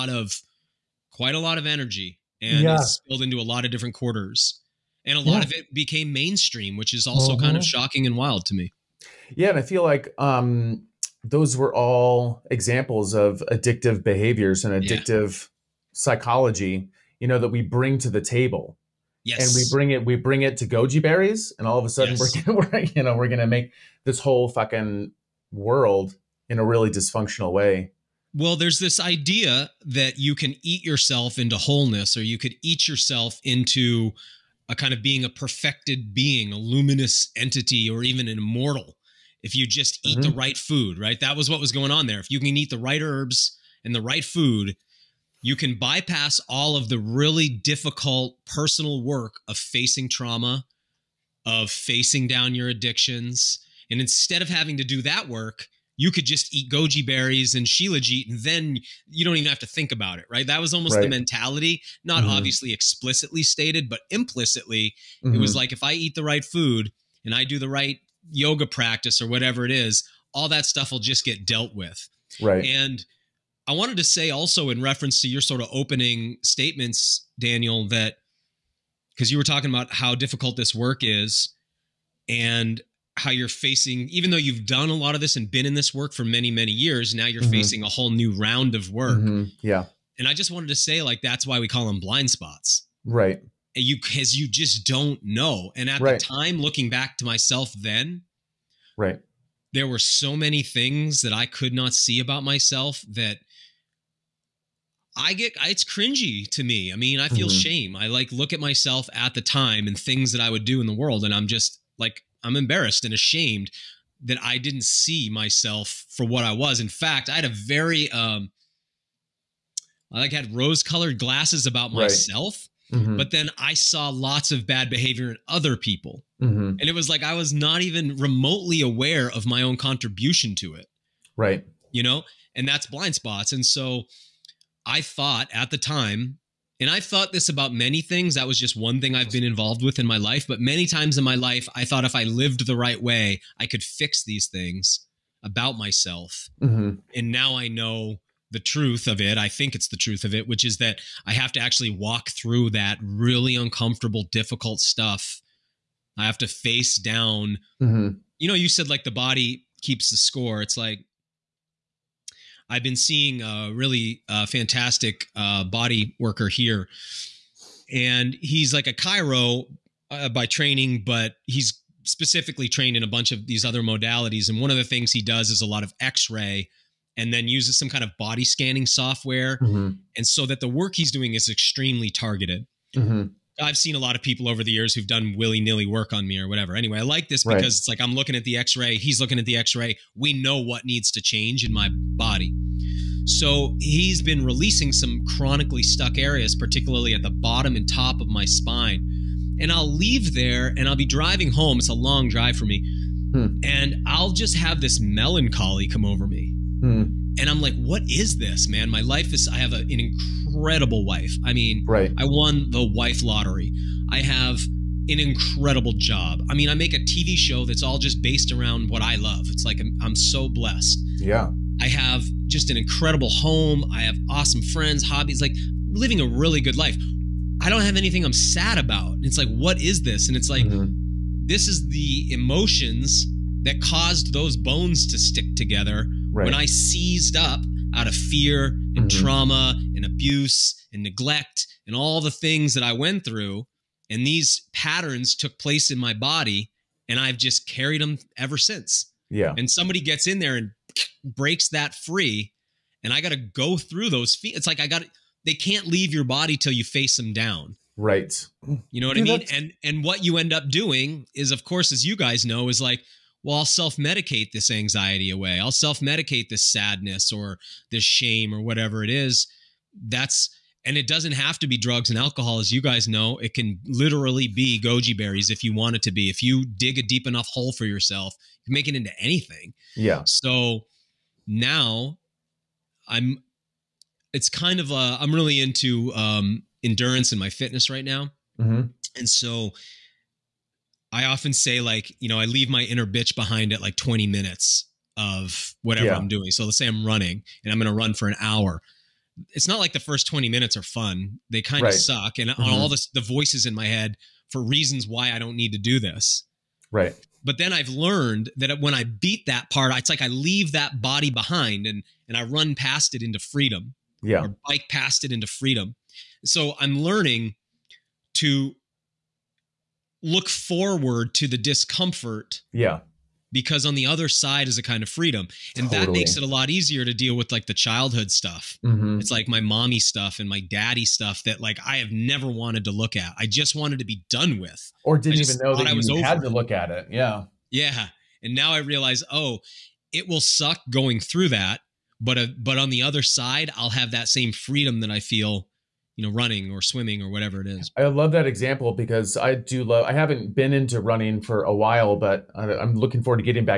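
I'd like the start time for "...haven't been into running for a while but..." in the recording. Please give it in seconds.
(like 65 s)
350 s.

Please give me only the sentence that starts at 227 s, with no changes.
I don't have anything I'm sad about.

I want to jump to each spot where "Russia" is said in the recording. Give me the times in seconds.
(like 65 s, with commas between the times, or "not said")
not said.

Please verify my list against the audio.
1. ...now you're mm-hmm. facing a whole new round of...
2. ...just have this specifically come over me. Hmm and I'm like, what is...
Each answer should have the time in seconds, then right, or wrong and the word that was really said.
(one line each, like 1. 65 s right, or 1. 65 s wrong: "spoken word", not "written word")
1. 87 s right
2. 204 s wrong: "melancholy", not "specifically".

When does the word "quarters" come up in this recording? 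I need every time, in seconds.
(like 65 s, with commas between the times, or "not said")
3 s.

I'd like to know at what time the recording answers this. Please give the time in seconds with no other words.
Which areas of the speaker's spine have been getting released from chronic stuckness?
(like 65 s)
197 s.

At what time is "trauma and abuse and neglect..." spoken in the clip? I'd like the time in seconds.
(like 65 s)
239 s.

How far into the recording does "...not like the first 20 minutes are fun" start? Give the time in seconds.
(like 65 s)
299 s.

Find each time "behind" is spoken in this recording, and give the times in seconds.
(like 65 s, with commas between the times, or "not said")
293 s, 311 s.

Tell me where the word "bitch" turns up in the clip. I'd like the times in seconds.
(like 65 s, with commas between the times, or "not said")
293 s.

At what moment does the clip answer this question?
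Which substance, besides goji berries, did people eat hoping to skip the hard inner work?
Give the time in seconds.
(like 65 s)
57 s.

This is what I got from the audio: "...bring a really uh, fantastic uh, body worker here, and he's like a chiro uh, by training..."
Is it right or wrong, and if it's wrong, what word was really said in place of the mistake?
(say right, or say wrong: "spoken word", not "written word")
wrong: "seeing", not "bring".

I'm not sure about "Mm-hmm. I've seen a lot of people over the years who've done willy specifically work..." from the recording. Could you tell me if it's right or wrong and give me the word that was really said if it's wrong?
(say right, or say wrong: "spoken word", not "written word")
wrong: "nilly", not "specifically".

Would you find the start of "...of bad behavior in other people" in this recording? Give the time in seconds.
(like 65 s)
124 s.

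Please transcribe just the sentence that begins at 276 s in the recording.
If you dig a deep enough hole for yourself, you can make it into anything.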